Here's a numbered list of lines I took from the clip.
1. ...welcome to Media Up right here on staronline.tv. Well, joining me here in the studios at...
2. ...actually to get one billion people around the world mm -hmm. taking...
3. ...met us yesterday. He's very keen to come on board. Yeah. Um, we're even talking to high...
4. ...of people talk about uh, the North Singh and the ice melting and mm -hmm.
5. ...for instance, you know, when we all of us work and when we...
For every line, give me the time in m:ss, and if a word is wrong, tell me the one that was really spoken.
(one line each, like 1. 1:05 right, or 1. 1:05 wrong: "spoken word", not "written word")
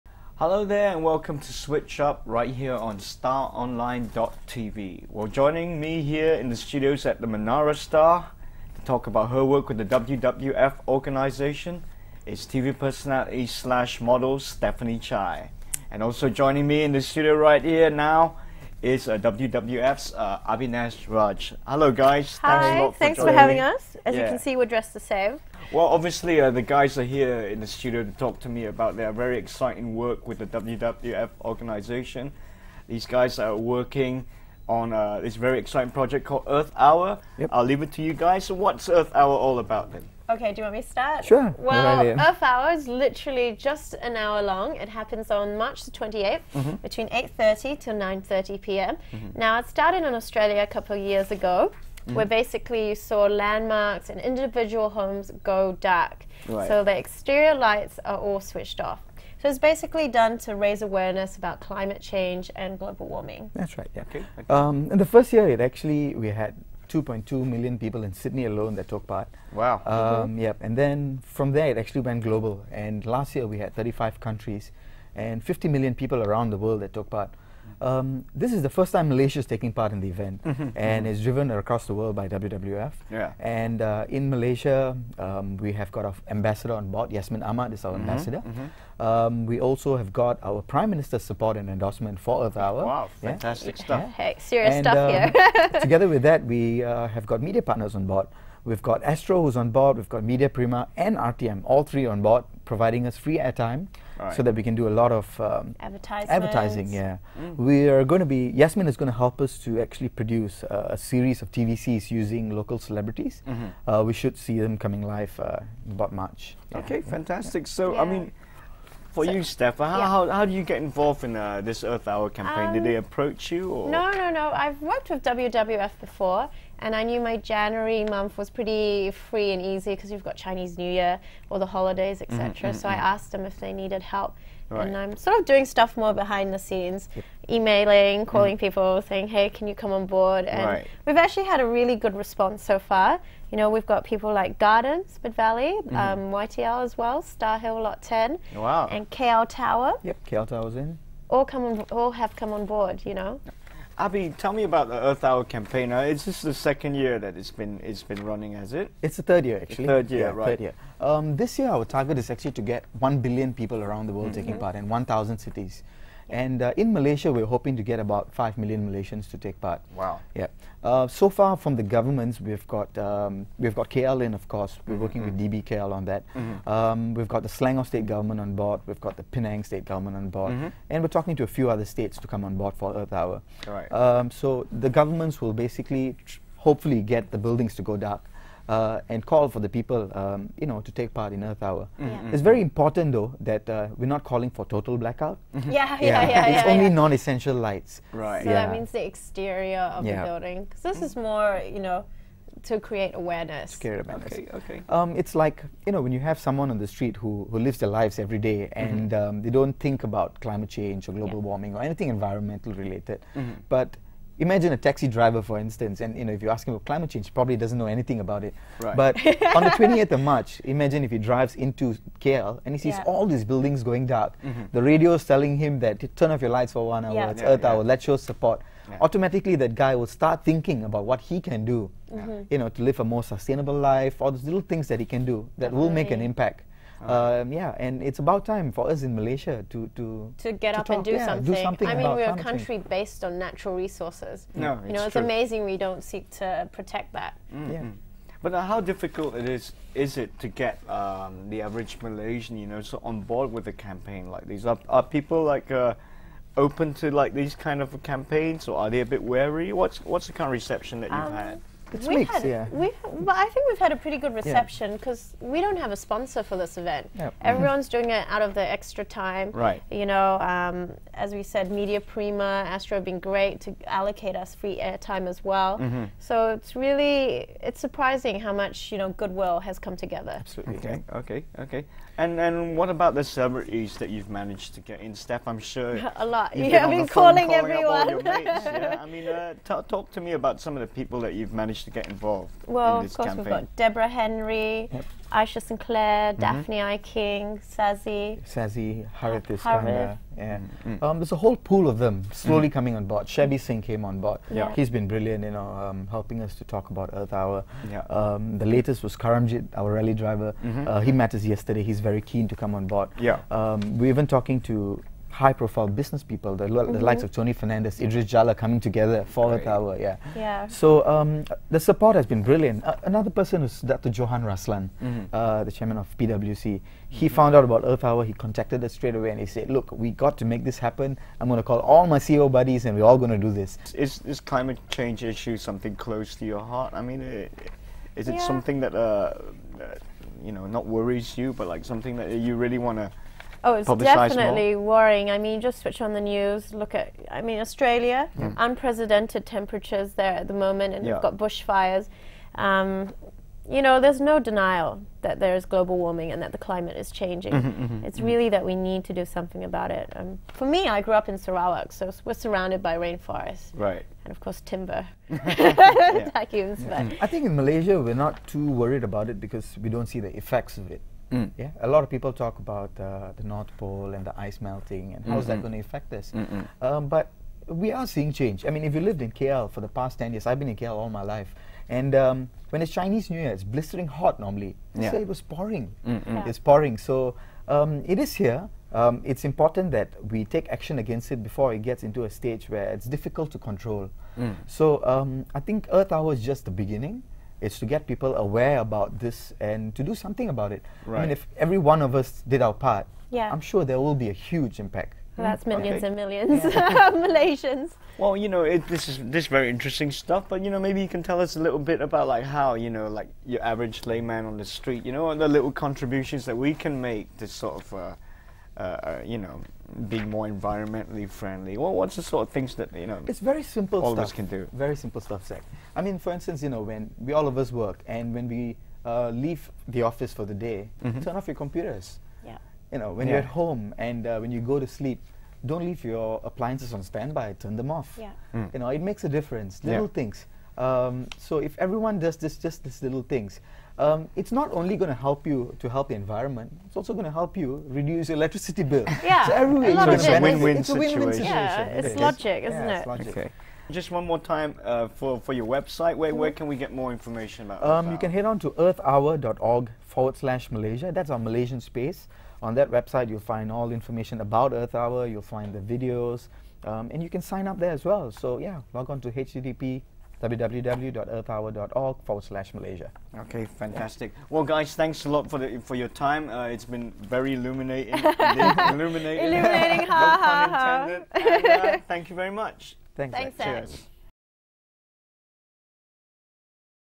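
1. 0:01 wrong: "Switch", not "Media"
2. 2:42 right
3. 5:11 right
4. 6:12 wrong: "Pole", not "Singh"
5. 7:06 right.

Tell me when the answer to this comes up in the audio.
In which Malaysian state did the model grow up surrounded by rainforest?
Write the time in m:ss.
6:01.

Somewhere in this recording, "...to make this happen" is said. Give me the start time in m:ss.
5:30.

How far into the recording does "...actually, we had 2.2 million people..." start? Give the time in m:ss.
1:05.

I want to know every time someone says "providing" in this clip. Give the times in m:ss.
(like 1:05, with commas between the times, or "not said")
1:42.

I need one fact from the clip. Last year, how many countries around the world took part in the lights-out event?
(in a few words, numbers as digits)
35.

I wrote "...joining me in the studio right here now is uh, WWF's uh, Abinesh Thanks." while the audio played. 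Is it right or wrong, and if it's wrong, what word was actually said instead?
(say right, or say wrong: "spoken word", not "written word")
wrong: "Raj", not "Thanks".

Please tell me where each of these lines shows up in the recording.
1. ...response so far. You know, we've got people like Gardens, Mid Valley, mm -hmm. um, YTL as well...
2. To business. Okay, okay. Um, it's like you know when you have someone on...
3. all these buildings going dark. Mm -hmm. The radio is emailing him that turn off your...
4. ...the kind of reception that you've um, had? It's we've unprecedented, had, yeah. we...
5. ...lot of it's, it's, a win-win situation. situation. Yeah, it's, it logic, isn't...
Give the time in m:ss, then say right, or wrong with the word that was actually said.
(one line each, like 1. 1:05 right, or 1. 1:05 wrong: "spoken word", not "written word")
1. 2:22 right
2. 3:23 wrong: "awareness", not "business"
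3. 3:43 wrong: "telling", not "emailing"
4. 4:20 wrong: "mixed", not "unprecedented"
5. 7:29 right.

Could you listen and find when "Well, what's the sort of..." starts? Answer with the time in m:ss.
7:01.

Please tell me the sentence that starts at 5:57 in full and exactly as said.
Mm -hmm, mm -hmm, it's mm -hmm.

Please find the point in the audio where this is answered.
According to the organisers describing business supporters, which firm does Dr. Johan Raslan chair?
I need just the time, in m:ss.
5:26.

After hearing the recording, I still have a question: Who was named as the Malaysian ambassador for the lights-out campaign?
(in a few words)
Yasmin Ahmad.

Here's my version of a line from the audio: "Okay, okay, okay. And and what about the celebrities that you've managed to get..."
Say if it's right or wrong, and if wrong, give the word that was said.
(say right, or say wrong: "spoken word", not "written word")
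right.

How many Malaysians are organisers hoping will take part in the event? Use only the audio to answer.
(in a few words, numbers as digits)
5 million.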